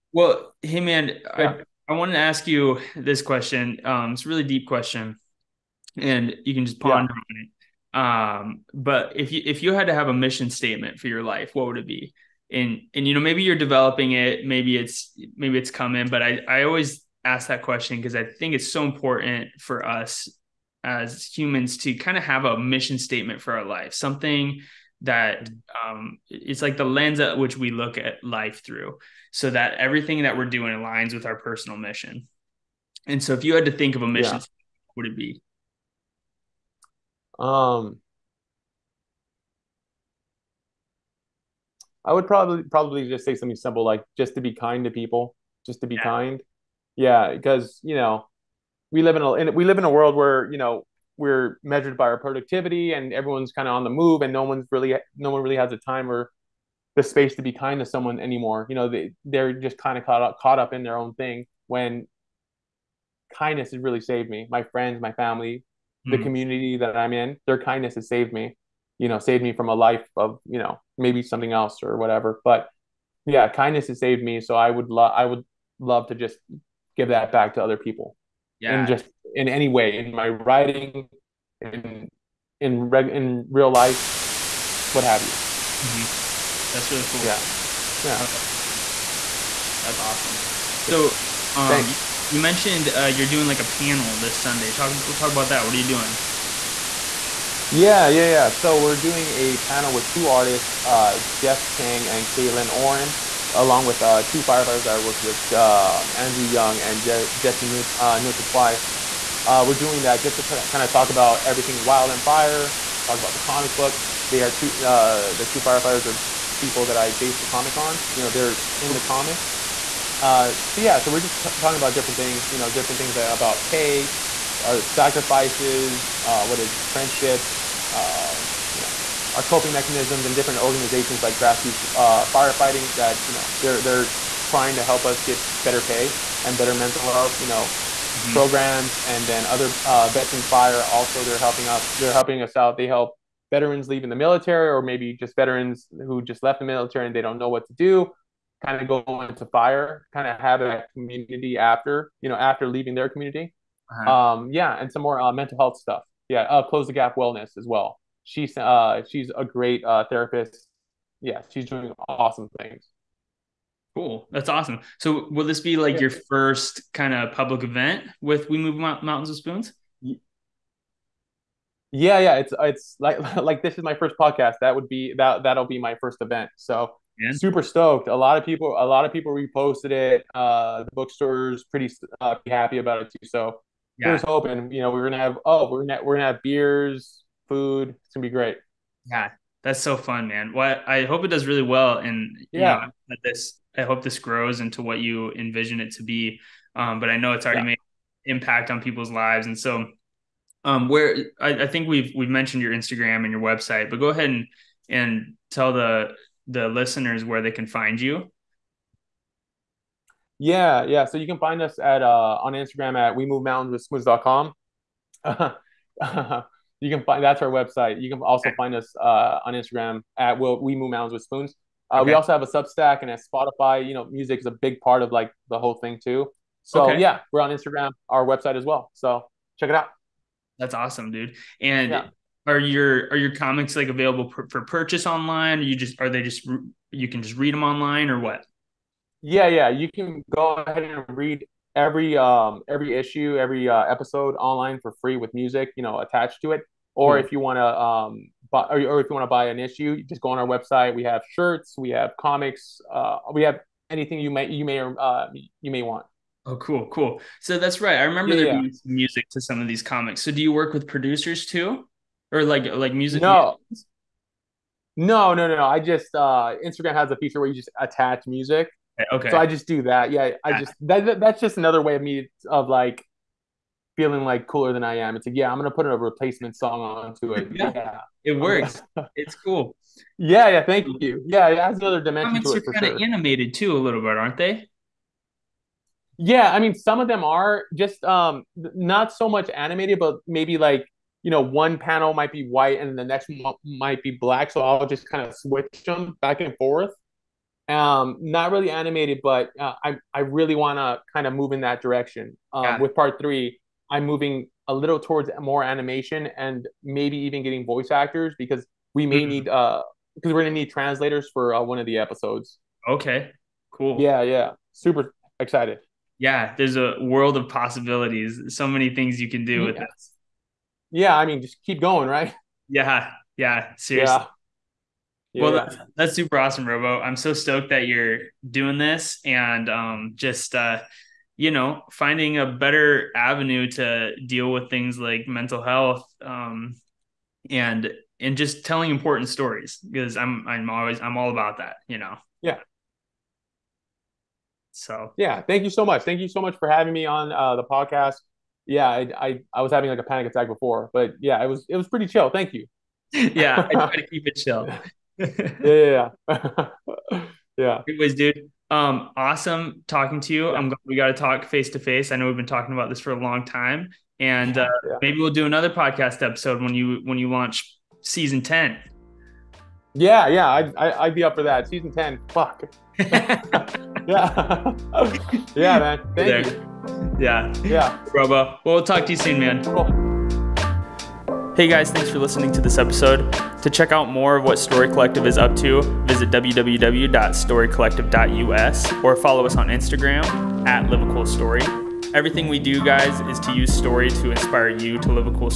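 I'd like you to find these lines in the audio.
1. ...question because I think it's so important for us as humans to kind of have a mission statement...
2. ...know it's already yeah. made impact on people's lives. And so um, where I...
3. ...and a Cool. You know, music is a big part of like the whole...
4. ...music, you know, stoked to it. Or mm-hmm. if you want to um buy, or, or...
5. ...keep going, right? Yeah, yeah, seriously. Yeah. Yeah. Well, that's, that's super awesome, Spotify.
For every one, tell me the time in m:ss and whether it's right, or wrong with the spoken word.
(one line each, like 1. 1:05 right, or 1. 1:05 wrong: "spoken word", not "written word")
1. 0:17 right
2. 3:17 right
3. 3:43 wrong: "Spotify", not "Cool"
4. 4:05 wrong: "attached", not "stoked"
5. 5:21 wrong: "Robo", not "Spotify".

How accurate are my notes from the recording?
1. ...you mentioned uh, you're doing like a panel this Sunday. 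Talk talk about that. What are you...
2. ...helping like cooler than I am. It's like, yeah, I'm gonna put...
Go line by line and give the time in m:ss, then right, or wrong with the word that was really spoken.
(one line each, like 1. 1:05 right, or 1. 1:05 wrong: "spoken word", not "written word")
1. 1:32 right
2. 4:34 wrong: "feeling", not "helping".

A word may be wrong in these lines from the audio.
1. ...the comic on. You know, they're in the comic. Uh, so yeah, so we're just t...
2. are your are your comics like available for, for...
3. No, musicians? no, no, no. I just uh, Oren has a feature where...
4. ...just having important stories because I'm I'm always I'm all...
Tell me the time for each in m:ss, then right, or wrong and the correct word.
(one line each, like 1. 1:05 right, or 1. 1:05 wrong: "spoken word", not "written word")
1. 1:57 right
2. 3:52 right
3. 4:23 wrong: "Instagram", not "Oren"
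4. 5:38 wrong: "telling", not "having".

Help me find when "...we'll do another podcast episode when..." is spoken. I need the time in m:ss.
6:05.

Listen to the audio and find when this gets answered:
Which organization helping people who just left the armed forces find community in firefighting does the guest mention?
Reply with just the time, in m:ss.
2:20.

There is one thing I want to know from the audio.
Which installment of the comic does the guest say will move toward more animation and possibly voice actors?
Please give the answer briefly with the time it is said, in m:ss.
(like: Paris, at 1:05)
Part 3, at 5:02.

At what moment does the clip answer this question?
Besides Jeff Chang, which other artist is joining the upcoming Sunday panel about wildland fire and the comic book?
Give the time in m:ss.
1:42.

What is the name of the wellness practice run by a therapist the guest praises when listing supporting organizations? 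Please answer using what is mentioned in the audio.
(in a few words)
Close the Gap Wellness.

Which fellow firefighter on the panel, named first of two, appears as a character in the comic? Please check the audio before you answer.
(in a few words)
Andrew Young.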